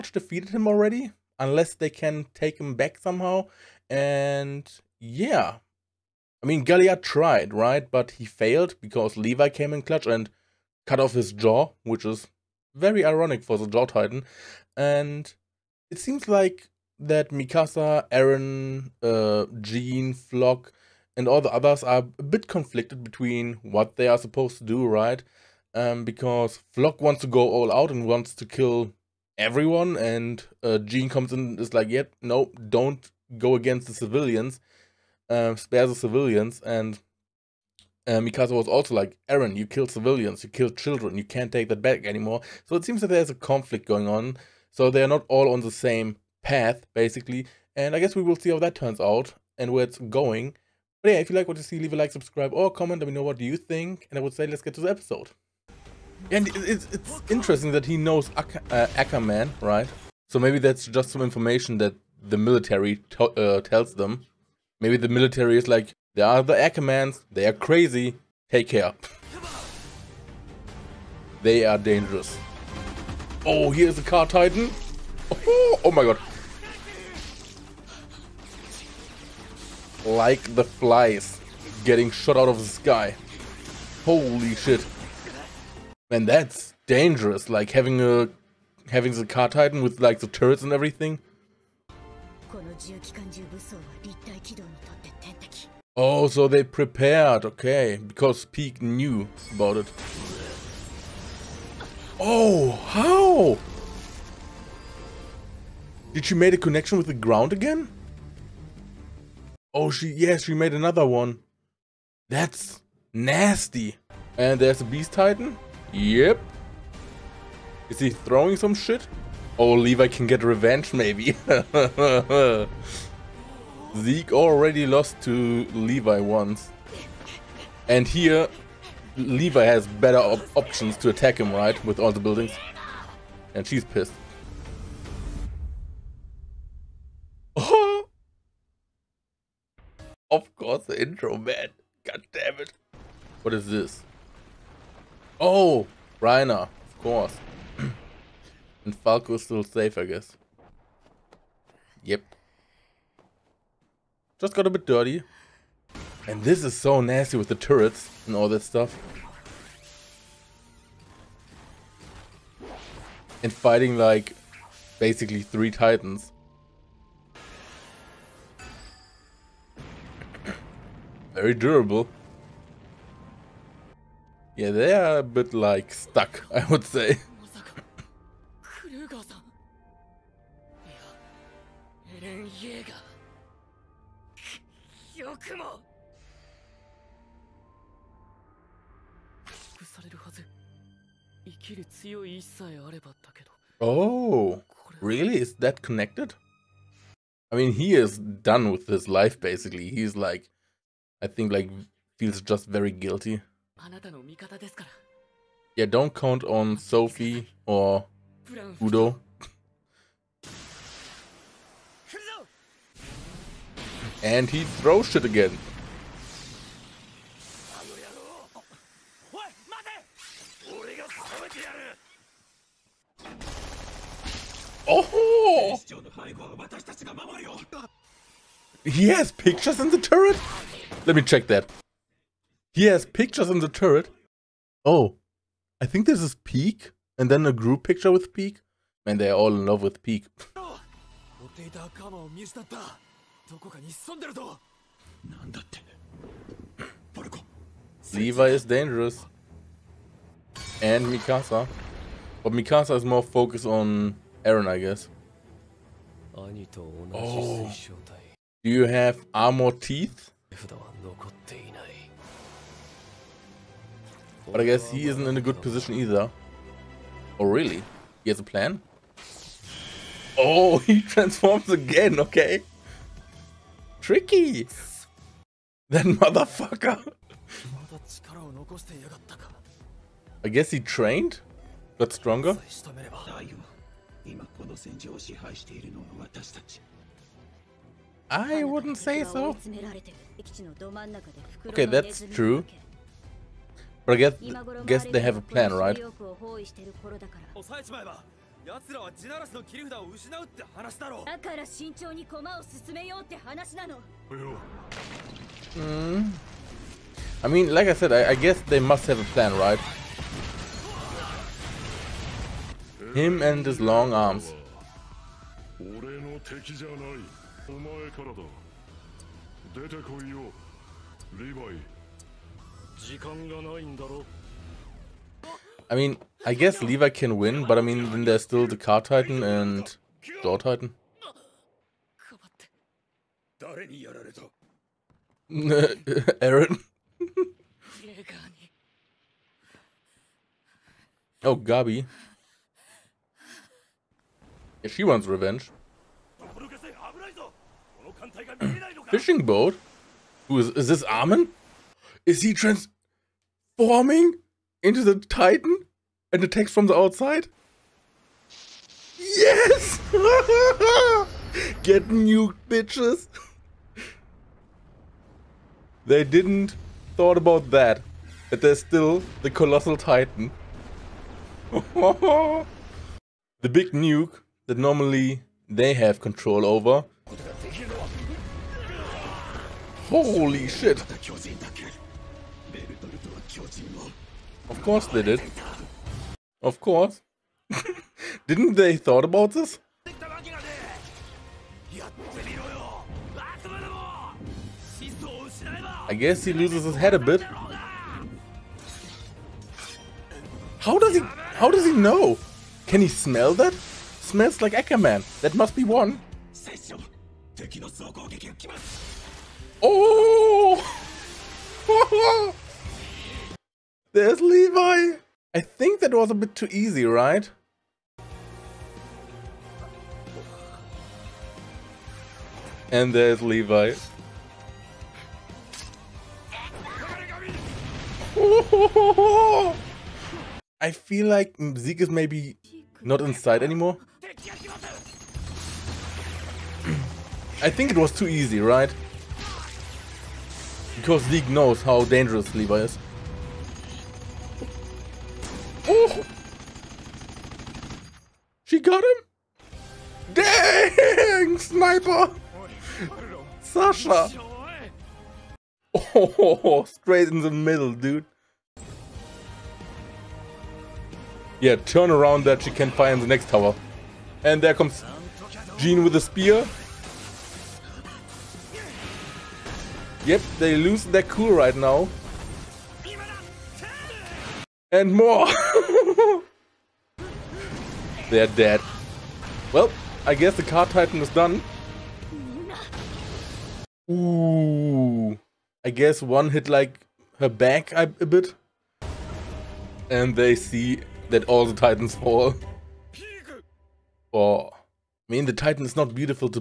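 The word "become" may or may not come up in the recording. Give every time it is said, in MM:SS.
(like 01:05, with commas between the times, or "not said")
not said.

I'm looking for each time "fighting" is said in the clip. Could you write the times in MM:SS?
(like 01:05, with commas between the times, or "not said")
02:43.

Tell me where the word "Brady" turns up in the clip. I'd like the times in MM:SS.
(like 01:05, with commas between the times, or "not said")
not said.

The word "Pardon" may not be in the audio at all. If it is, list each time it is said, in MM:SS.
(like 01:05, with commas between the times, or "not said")
not said.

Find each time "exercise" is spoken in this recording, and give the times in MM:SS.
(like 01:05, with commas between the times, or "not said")
not said.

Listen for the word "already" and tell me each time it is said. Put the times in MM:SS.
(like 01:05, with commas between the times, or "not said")
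00:00, 02:04.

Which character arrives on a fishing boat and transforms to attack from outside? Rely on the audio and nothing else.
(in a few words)
Armin.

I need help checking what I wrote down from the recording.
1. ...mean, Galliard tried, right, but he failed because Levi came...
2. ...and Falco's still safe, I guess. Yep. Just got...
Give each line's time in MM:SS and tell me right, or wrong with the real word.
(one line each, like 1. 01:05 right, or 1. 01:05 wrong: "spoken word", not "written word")
1. 00:06 right
2. 02:28 right.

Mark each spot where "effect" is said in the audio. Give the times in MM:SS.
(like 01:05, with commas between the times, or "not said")
not said.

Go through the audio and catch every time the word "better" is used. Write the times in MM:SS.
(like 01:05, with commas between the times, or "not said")
02:09.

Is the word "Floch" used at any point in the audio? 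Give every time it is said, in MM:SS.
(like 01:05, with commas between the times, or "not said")
00:20, 00:26.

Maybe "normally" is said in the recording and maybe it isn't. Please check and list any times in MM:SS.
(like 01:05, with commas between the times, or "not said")
06:14.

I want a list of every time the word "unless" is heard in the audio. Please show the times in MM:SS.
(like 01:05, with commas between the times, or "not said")
00:01.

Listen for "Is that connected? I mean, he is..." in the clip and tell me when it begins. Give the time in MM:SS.
03:15.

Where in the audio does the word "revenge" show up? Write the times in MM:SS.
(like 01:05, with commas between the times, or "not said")
02:00, 05:45.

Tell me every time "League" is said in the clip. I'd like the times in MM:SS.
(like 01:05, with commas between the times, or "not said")
07:21.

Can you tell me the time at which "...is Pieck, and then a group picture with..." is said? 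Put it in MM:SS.
03:56.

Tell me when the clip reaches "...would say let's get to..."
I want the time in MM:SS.
00:54.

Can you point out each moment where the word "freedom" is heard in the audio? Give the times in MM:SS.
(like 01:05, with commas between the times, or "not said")
not said.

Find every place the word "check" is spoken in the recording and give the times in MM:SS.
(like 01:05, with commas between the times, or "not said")
03:51.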